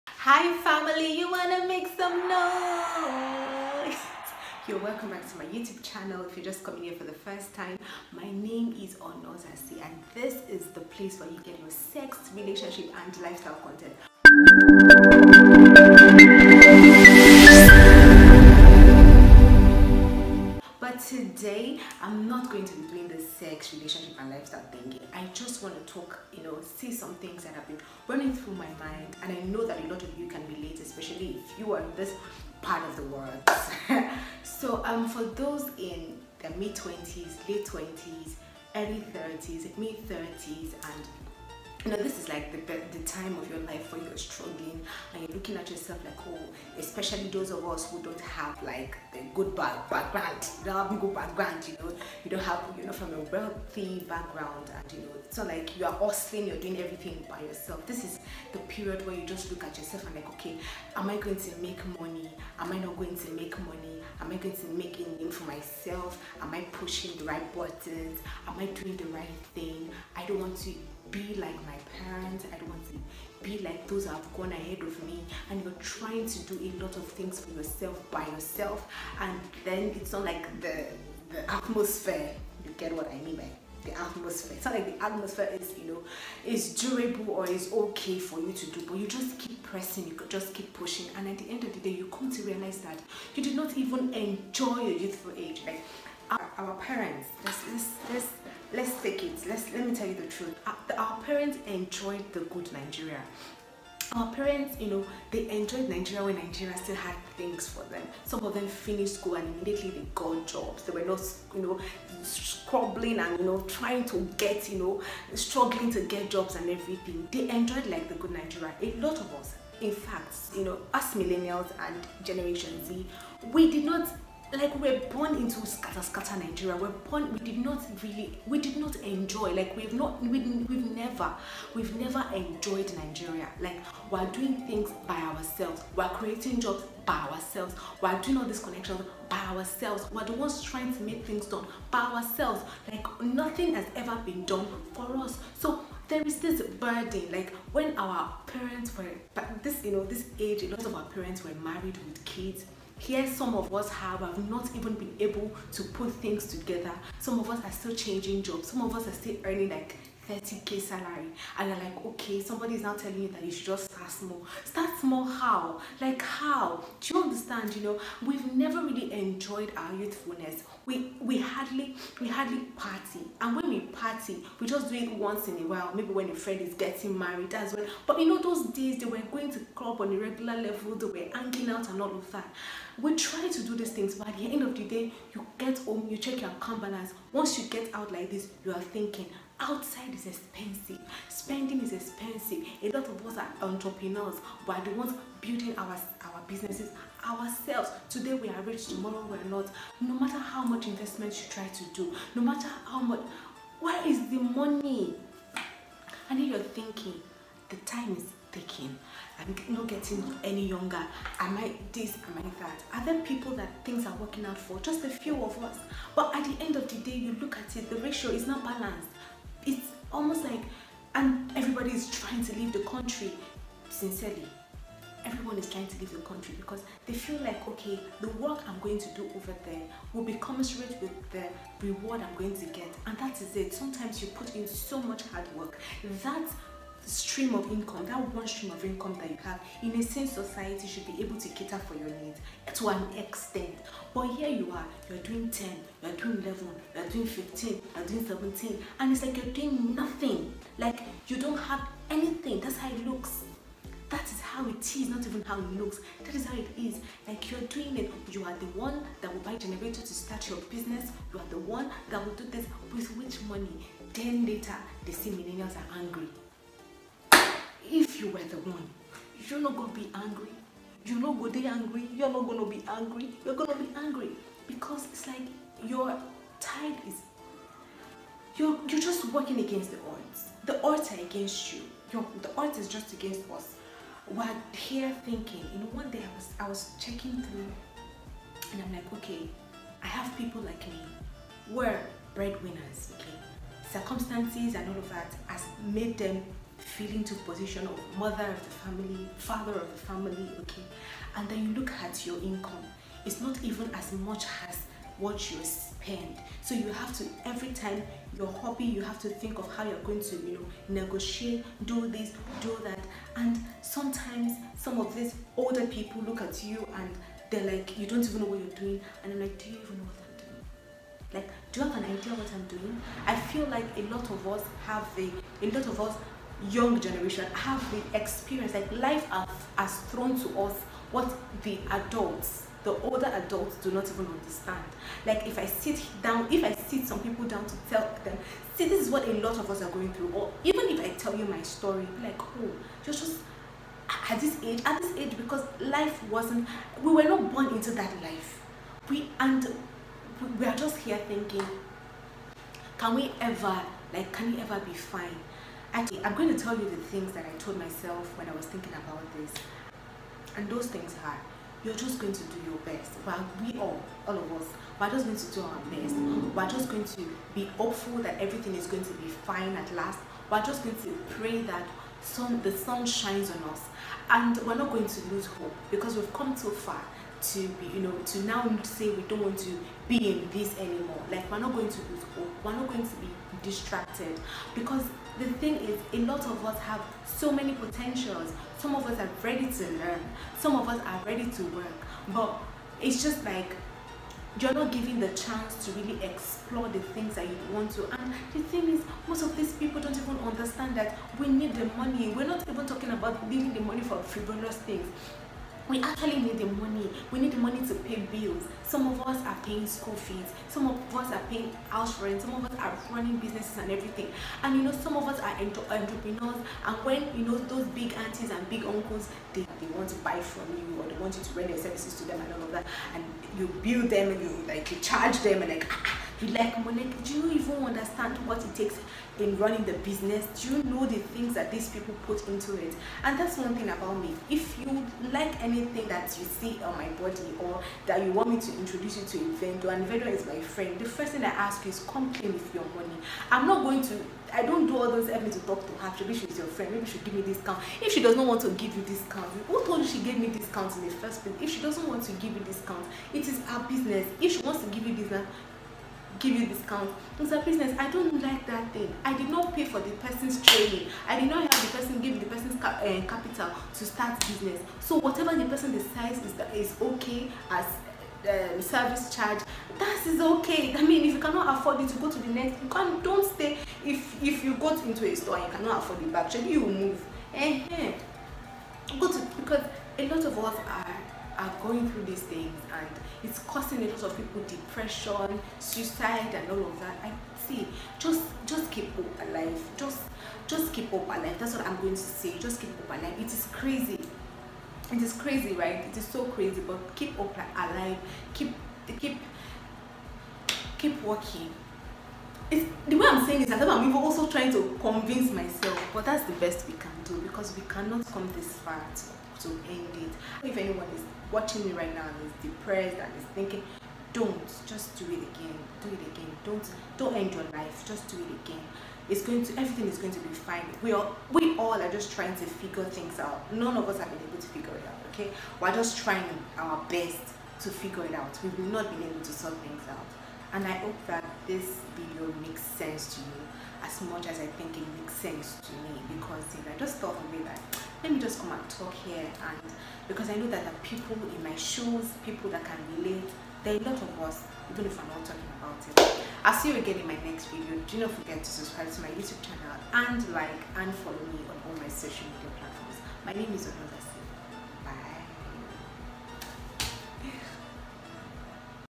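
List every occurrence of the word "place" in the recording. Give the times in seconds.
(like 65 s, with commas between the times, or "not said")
10 s, 451 s.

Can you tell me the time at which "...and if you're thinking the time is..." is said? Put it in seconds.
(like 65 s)
206 s.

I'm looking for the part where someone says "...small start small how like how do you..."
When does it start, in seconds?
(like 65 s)
164 s.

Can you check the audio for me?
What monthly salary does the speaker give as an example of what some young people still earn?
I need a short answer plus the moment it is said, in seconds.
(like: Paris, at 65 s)
30k, at 160 s.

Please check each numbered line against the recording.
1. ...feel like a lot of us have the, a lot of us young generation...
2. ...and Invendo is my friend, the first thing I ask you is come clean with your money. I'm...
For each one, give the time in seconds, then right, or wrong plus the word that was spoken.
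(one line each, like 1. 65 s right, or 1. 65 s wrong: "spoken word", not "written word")
1. 323 s right
2. 439 s right.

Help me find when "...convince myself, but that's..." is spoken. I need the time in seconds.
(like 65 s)
505 s.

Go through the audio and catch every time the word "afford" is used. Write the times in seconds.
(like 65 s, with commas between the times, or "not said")
471 s, 475 s.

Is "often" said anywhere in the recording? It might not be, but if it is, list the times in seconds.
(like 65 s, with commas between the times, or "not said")
not said.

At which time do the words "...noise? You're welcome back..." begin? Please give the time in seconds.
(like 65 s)
2 s.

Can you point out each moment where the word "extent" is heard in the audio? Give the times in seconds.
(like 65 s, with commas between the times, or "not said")
243 s.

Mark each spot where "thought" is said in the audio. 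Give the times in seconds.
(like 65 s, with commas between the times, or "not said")
537 s.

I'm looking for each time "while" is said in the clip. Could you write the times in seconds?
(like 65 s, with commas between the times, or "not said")
175 s, 363 s.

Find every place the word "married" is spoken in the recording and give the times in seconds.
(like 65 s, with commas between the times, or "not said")
151 s, 177 s.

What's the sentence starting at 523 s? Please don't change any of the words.
None of us have been able to figure it out, okay?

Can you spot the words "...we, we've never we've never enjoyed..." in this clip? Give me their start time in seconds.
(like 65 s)
130 s.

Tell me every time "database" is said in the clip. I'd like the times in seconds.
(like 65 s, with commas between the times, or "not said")
not said.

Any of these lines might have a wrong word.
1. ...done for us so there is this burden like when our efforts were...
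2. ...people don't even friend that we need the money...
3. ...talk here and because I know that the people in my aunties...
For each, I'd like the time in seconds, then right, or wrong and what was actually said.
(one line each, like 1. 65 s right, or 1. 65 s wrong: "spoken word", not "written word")
1. 144 s wrong: "parents", not "efforts"
2. 399 s wrong: "understand", not "friend"
3. 538 s wrong: "shoes", not "aunties".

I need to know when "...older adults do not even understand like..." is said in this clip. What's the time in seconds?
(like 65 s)
333 s.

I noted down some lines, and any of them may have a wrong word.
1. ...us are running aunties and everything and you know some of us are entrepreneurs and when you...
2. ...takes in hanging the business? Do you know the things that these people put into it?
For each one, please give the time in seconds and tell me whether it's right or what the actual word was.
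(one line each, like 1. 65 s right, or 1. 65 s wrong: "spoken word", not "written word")
1. 412 s wrong: "businesses", not "aunties"
2. 428 s wrong: "running", not "hanging".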